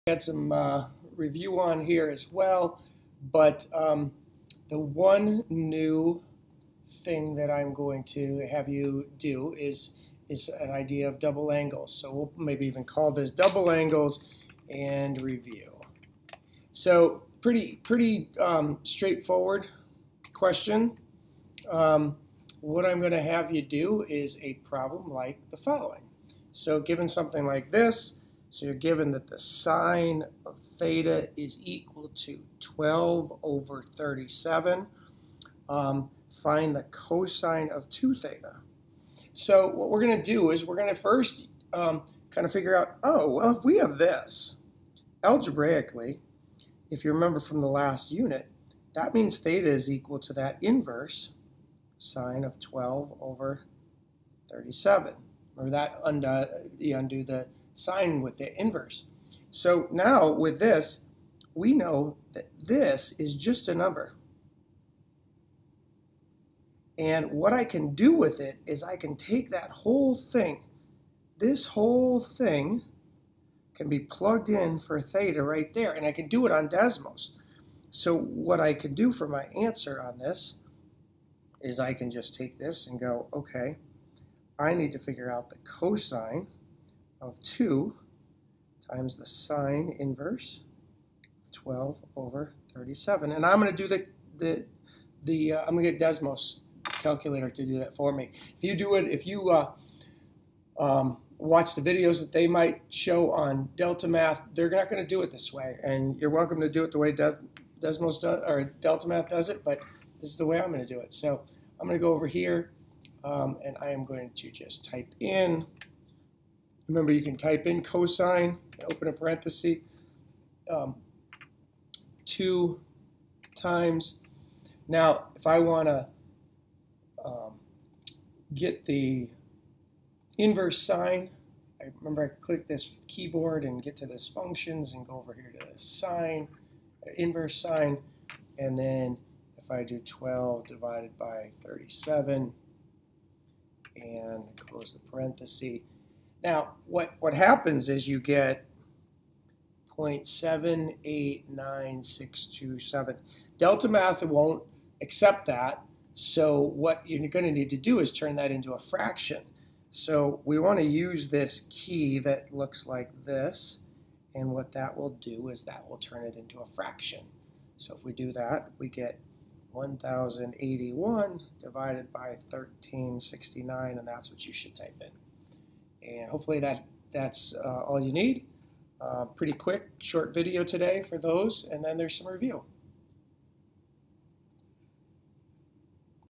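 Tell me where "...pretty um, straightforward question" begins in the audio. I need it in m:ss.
0:17.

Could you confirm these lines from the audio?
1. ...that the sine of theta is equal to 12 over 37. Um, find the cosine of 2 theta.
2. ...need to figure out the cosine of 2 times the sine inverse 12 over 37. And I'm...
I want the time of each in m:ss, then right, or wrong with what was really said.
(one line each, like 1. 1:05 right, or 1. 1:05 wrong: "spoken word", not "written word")
1. 0:29 right
2. 1:24 right.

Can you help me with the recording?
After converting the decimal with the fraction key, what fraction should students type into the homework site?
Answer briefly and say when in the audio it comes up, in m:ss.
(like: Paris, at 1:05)
1081/1369, at 2:49.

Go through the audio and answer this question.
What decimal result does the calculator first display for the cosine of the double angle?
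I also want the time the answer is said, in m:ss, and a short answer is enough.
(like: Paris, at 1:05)
0.789627, at 2:29.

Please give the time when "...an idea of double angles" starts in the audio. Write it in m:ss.
0:10.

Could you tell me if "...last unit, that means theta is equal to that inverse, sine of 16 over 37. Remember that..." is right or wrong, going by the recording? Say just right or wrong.
wrong.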